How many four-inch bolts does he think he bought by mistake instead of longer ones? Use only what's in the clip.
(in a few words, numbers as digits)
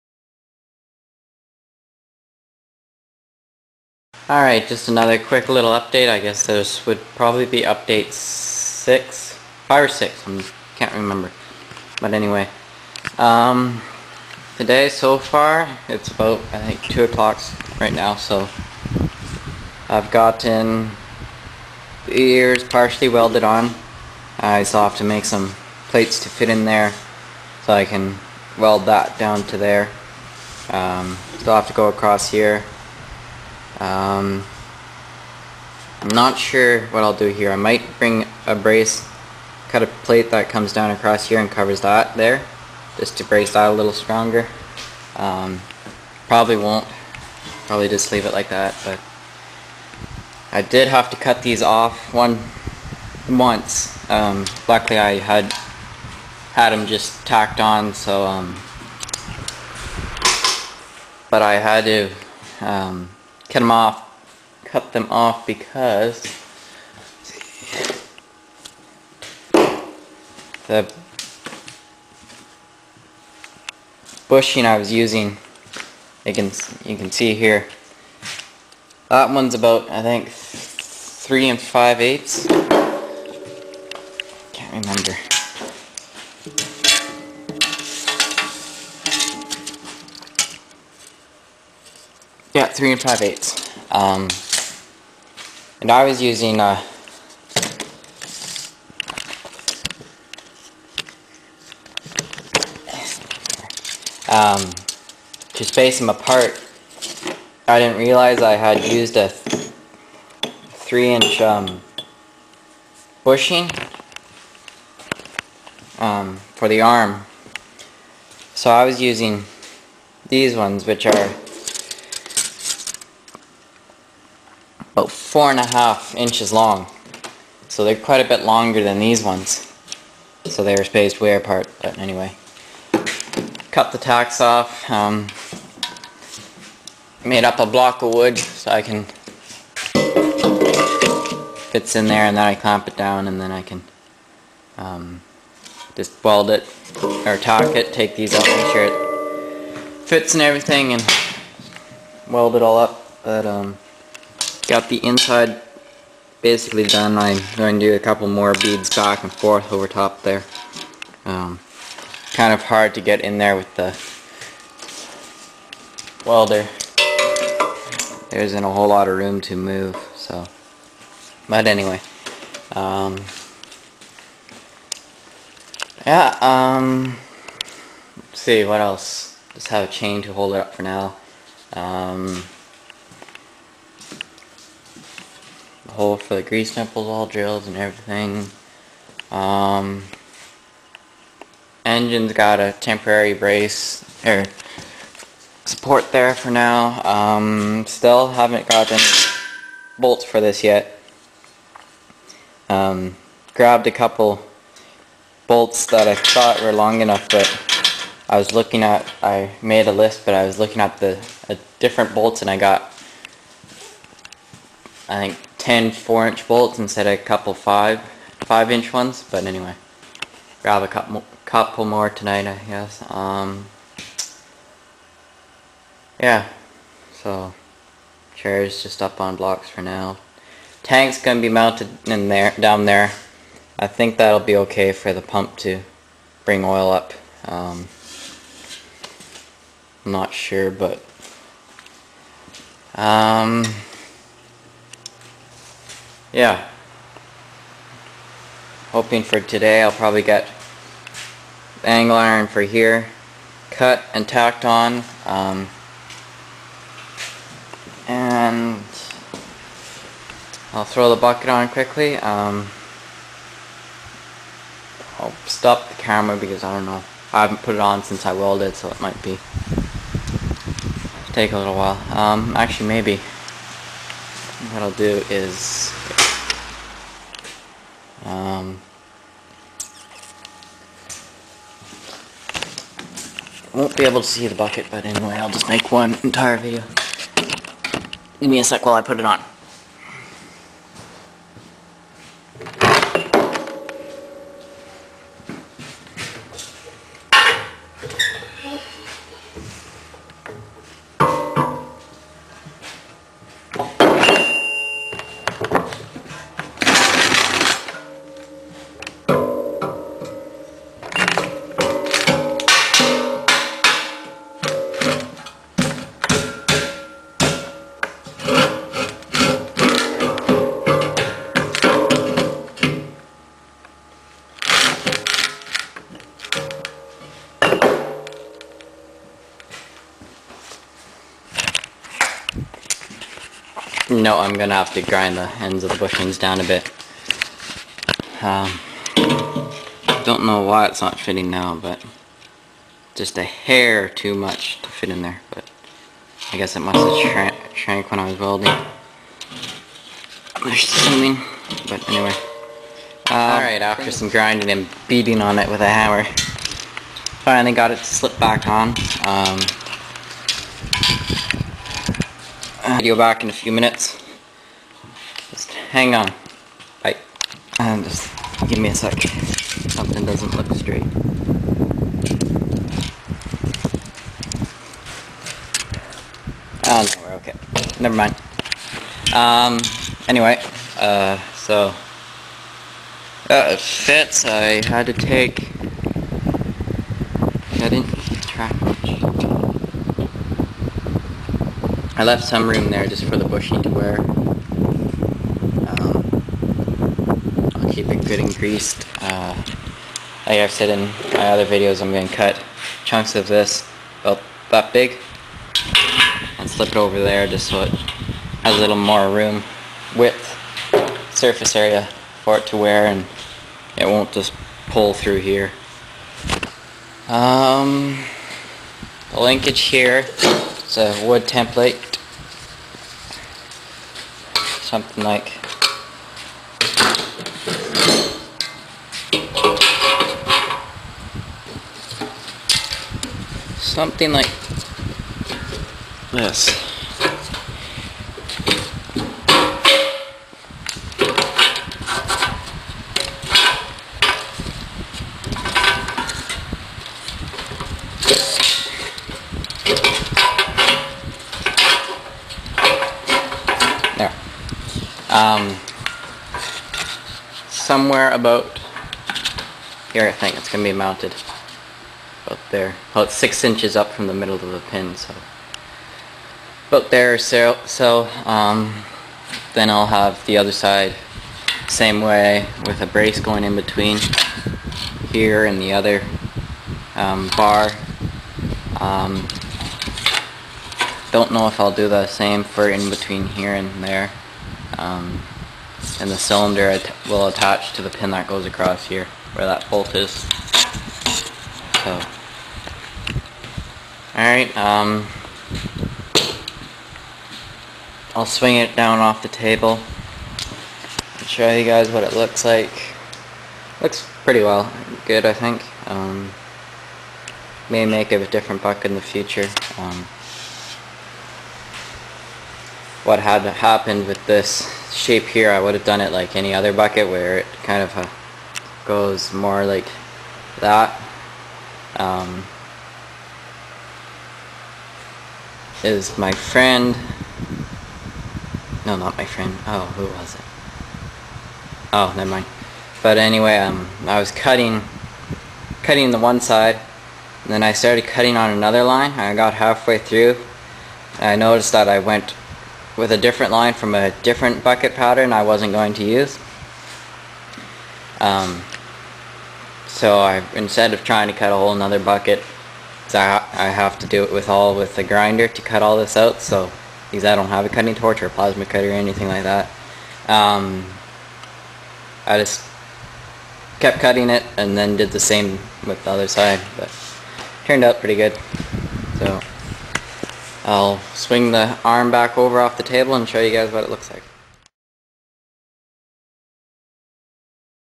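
10.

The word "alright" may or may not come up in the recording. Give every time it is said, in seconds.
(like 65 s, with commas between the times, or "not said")
4 s, 353 s, 494 s.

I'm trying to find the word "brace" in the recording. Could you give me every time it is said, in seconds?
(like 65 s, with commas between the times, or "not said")
38 s, 43 s, 193 s, 473 s.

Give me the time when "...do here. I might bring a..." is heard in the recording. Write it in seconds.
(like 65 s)
37 s.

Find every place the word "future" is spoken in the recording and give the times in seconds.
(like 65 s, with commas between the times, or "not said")
509 s.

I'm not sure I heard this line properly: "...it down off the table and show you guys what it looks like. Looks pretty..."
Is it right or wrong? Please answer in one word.
right.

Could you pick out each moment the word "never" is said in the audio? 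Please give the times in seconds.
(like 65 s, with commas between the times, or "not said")
377 s, 532 s.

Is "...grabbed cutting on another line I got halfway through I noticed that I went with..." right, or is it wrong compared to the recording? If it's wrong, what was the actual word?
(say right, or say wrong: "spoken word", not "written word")
wrong: "started", not "grabbed".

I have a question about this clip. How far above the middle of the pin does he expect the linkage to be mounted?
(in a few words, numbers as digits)
6 inches.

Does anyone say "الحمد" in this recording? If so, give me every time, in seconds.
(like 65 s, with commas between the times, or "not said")
not said.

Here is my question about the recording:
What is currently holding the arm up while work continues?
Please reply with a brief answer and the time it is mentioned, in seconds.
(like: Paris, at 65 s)
a chain, at 179 s.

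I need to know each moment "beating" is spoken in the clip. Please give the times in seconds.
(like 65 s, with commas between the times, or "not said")
355 s.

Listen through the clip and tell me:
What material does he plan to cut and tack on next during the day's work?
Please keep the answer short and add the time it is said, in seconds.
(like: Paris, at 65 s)
angle iron, at 251 s.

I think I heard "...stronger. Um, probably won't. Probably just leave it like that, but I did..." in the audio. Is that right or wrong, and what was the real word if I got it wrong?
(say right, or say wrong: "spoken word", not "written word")
right.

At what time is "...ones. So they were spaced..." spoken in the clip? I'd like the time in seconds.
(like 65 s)
129 s.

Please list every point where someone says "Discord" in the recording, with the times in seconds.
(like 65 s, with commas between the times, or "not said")
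not said.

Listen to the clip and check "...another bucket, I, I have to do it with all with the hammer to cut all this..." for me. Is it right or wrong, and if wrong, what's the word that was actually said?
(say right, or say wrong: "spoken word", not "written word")
wrong: "grinder", not "hammer".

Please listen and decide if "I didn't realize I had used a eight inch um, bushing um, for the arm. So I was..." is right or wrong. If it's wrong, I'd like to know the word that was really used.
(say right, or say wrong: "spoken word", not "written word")
wrong: "three", not "eight".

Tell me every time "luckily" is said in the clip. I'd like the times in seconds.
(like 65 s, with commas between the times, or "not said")
54 s.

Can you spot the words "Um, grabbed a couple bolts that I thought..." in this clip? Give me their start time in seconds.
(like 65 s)
202 s.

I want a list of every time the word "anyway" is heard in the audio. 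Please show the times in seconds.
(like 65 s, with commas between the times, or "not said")
12 s, 131 s, 171 s, 219 s, 285 s, 352 s, 380 s, 533 s.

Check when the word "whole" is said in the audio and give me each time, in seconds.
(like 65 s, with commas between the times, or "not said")
168 s, 551 s.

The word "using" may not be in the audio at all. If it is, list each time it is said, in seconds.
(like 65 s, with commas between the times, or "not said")
74 s, 96 s, 119 s.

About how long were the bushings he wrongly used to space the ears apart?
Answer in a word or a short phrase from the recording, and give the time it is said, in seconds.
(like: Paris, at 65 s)
4.5 inches, at 125 s.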